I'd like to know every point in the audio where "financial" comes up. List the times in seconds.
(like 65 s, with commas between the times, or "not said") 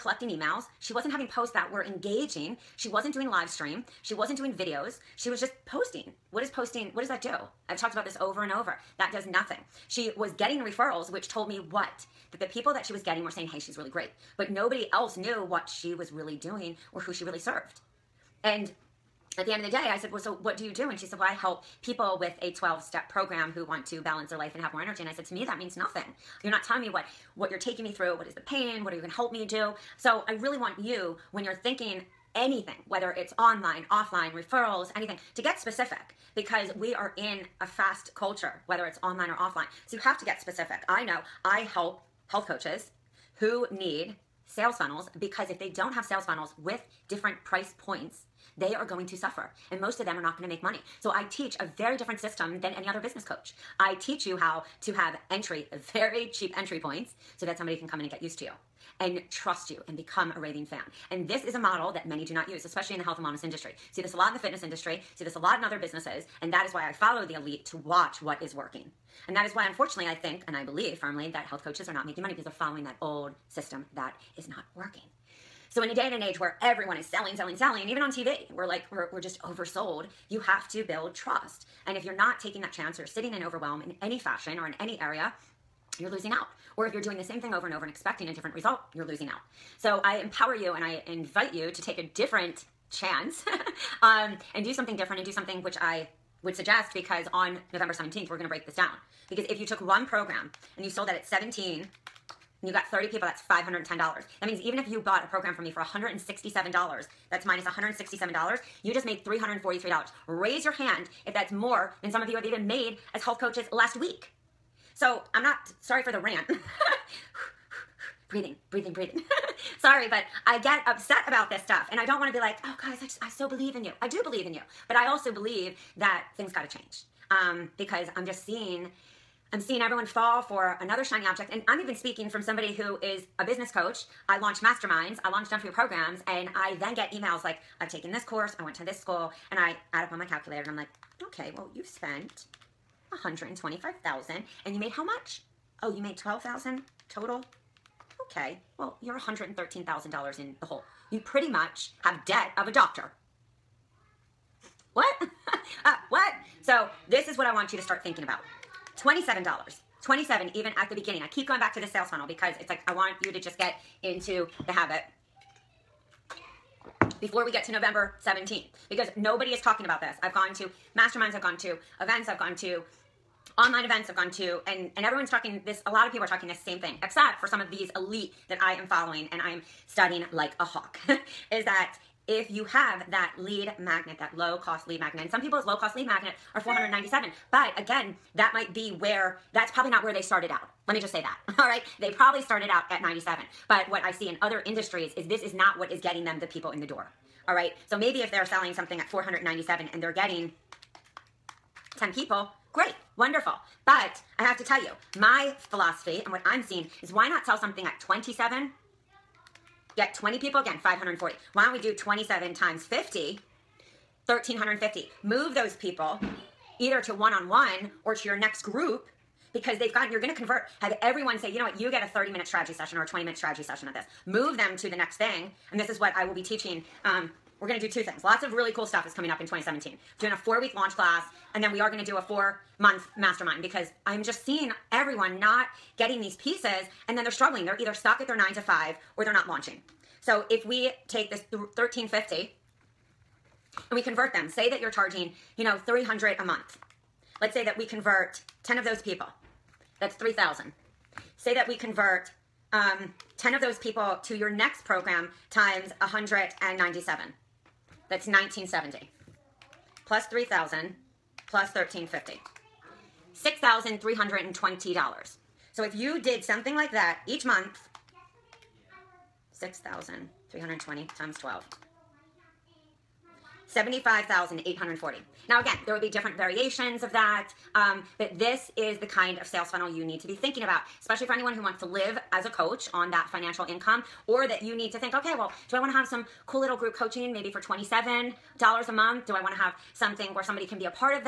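283 s.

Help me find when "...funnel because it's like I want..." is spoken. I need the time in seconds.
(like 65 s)
162 s.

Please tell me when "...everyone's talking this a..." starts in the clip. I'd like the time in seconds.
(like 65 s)
175 s.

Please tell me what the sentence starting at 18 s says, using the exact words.
And at the end of the day, I said, Well, so what do you do?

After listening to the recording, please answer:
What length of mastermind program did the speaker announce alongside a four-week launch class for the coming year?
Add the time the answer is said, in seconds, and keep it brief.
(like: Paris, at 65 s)
four month, at 232 s.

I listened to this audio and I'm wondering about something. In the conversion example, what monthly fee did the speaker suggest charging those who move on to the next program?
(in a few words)
300.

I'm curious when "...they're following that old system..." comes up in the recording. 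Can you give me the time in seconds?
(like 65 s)
72 s.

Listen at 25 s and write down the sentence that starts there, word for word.
And I said, To me, that means nothing.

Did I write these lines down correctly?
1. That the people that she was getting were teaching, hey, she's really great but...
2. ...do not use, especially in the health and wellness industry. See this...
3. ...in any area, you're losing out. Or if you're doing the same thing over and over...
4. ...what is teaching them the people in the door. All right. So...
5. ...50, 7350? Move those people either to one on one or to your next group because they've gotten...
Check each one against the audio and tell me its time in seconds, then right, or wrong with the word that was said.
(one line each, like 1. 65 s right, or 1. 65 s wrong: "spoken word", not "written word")
1. 12 s wrong: "saying", not "teaching"
2. 62 s right
3. 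84 s right
4. 195 s wrong: "getting", not "teaching"
5. 212 s wrong: "1350", not "7350".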